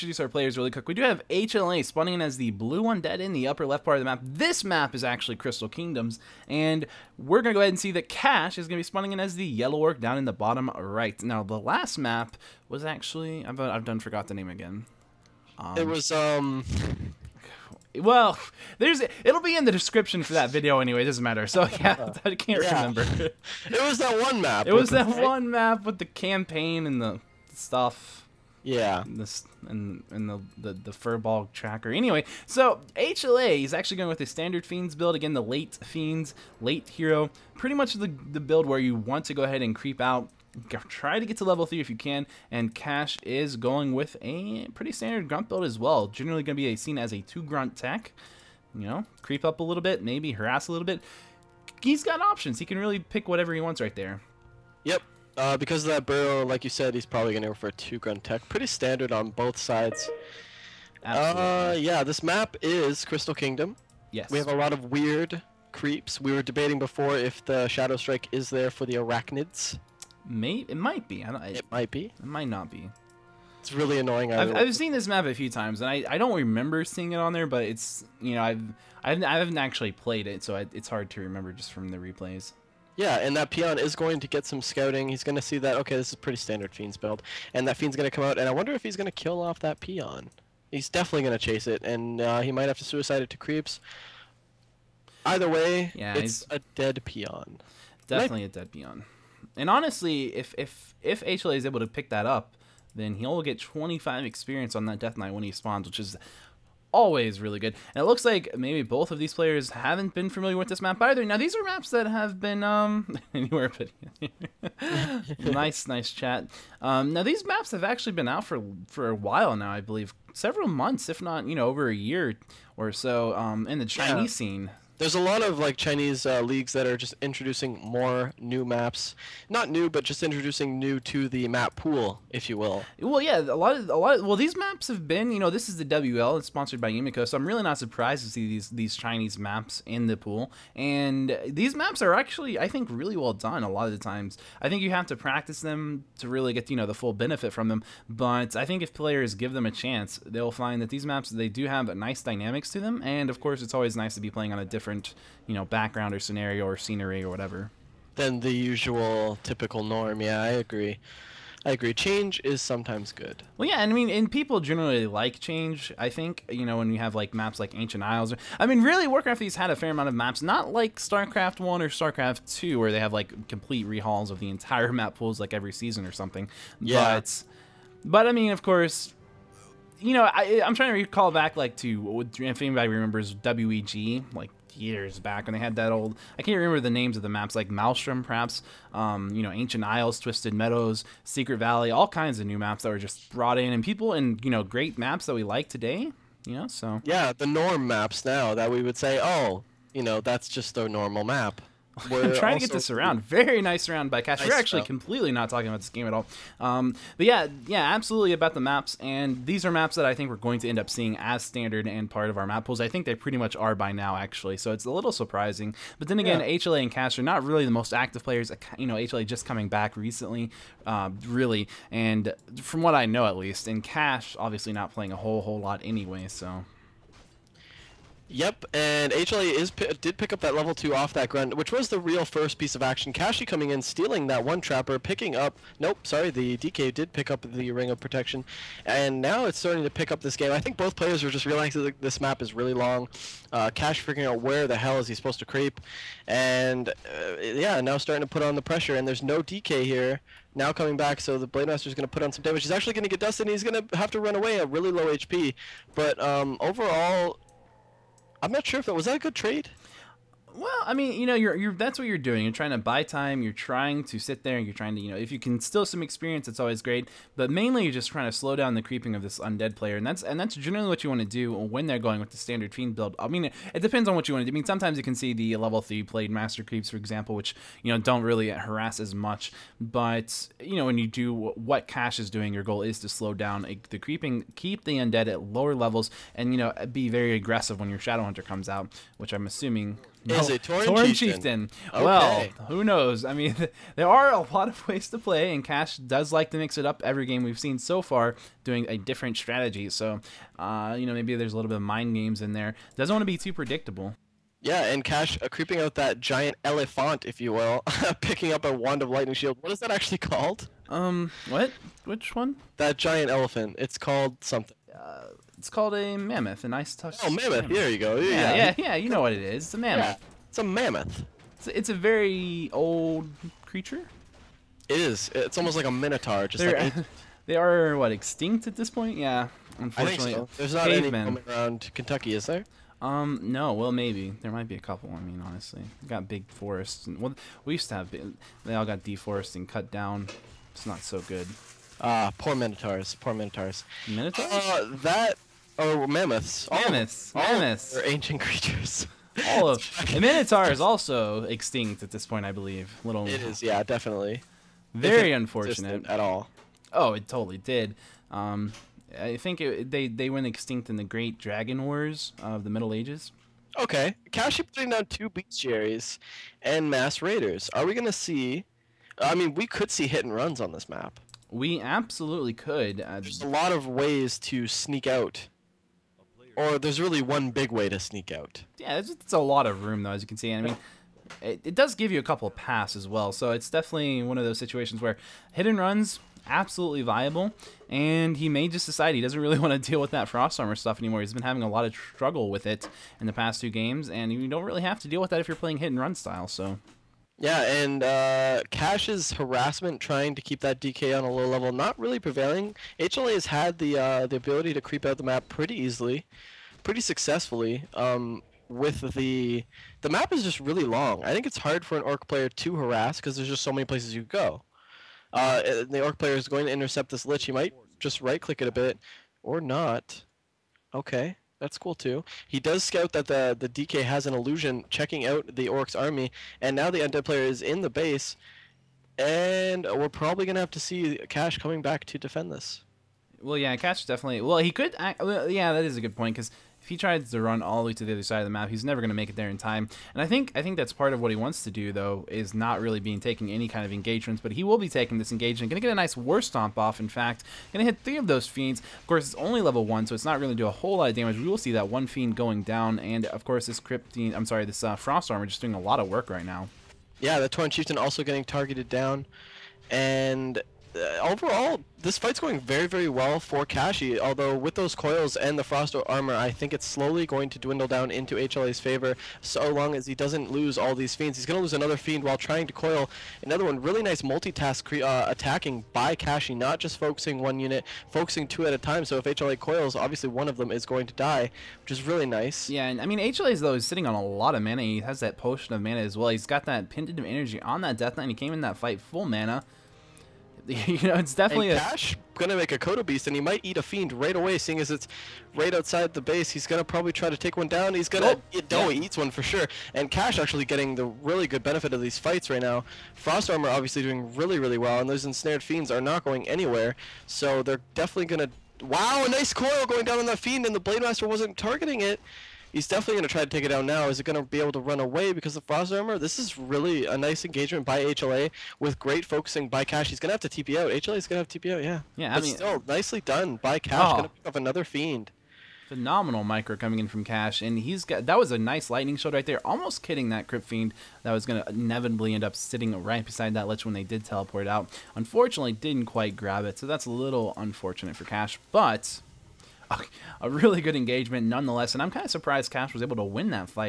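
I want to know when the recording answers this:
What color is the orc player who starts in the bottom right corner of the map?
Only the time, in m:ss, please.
0:09.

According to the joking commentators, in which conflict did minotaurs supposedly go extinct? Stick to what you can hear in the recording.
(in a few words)
Great Dragon Wars.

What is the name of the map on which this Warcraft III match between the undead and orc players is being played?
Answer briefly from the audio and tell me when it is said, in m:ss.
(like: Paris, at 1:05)
Crystal Kingdoms, at 0:05.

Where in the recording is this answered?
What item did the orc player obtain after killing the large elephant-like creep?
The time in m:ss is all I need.
5:08.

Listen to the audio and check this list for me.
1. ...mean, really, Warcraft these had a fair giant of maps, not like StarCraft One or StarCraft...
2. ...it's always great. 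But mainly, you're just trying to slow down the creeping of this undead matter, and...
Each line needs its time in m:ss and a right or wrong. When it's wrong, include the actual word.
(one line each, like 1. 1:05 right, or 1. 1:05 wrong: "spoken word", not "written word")
1. 2:48 wrong: "amount", not "giant"
2. 4:26 wrong: "player", not "matter".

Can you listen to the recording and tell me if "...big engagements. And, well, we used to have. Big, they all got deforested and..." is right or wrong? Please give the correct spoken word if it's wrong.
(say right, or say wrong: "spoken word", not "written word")
wrong: "forests", not "engagements".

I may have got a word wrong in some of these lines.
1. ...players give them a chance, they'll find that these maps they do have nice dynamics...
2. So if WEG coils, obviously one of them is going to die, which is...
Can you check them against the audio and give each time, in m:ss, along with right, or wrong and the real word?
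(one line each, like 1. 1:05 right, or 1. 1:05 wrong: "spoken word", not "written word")
1. 2:28 right
2. 7:59 wrong: "HLA", not "WEG".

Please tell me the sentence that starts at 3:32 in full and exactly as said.
I think they pretty much are by now, actually.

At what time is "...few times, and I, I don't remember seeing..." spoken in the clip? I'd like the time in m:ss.
1:15.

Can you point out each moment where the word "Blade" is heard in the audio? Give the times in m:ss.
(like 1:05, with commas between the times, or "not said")
4:11, 4:36, 8:30.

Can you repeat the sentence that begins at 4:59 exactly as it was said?
So, uh, you know, maybe there's a little bit of mind games in there.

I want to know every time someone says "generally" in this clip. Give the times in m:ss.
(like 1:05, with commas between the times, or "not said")
0:46, 2:44, 4:30.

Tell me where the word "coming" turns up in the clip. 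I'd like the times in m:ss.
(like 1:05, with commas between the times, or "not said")
3:39, 3:53, 4:10, 7:11, 8:46.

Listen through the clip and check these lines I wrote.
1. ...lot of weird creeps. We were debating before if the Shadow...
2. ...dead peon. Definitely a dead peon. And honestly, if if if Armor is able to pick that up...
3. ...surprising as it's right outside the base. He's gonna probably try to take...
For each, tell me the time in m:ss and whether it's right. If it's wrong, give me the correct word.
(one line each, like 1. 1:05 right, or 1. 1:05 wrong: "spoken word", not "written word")
1. 1:04 right
2. 1:36 wrong: "HLA", not "Armor"
3. 8:14 wrong: "seeing", not "surprising".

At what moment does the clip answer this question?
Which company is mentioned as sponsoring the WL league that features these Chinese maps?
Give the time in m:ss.
2:16.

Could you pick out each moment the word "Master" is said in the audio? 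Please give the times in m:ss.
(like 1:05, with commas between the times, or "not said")
4:11, 4:36, 8:31.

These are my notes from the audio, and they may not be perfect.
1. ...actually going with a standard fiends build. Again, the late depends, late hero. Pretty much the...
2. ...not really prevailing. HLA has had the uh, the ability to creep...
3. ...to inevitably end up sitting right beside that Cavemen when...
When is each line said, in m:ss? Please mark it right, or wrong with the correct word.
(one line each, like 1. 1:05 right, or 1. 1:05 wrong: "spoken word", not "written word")
1. 0:33 wrong: "fiends", not "depends"
2. 6:41 right
3. 8:51 wrong: "Lich", not "Cavemen".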